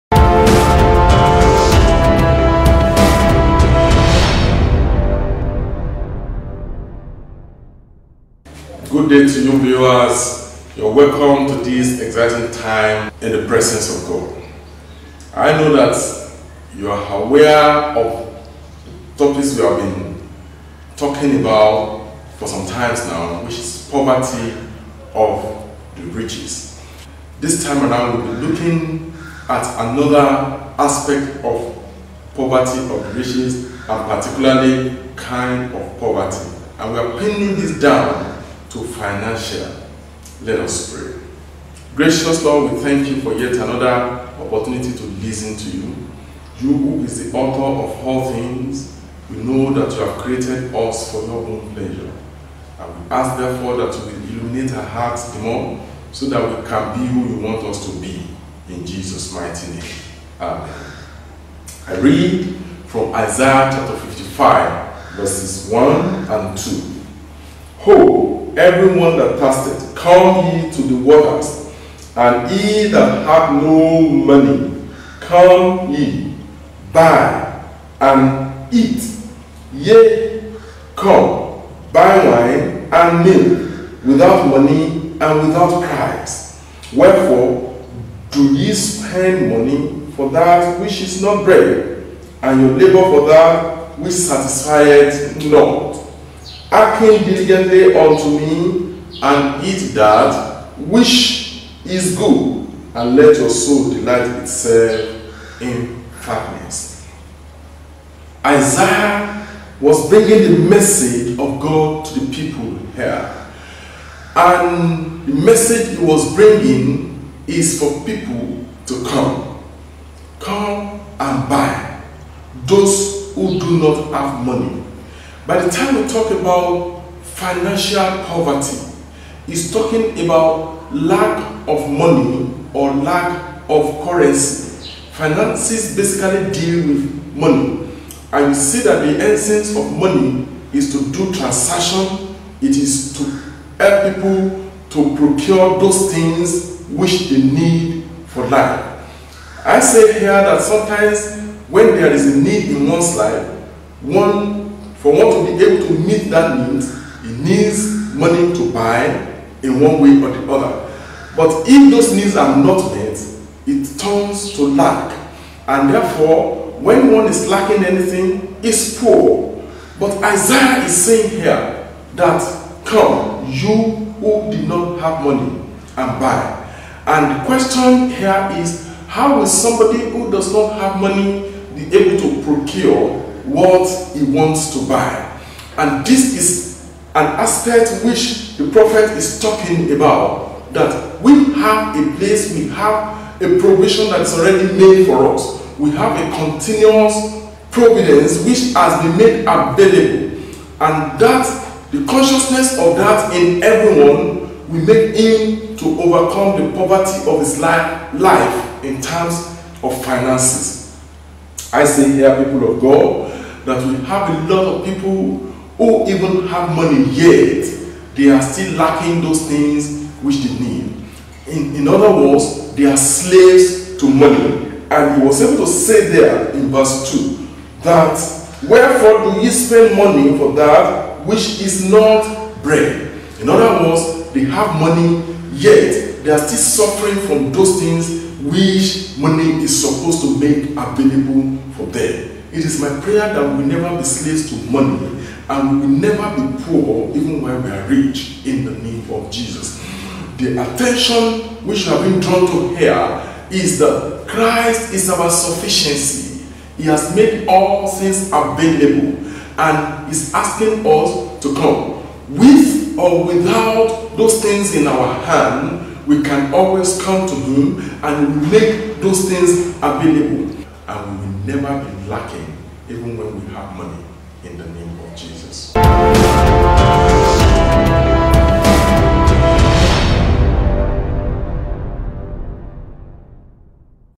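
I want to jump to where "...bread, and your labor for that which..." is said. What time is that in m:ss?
1:31.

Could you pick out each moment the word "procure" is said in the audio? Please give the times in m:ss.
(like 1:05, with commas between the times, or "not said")
2:25, 3:02.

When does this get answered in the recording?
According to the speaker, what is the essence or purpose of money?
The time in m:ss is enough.
2:20.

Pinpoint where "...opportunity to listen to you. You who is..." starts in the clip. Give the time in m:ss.
0:44.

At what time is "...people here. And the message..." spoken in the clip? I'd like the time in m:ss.
1:52.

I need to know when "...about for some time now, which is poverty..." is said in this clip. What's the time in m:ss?
0:21.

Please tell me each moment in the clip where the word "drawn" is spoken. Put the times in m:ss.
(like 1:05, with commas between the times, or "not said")
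4:12.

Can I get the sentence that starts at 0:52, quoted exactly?
And we ask therefore that you will illuminate our hearts more so that we can be who you want us to be.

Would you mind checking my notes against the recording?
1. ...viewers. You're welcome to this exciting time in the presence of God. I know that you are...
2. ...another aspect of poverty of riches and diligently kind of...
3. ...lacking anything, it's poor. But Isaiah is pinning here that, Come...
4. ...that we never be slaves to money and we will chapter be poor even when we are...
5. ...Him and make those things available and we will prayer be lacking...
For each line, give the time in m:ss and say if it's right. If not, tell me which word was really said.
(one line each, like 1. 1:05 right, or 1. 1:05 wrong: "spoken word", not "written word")
1. 0:09 right
2. 0:29 wrong: "particularly", not "diligently"
3. 2:47 wrong: "saying", not "pinning"
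4. 4:03 wrong: "never", not "chapter"
5. 4:27 wrong: "never", not "prayer".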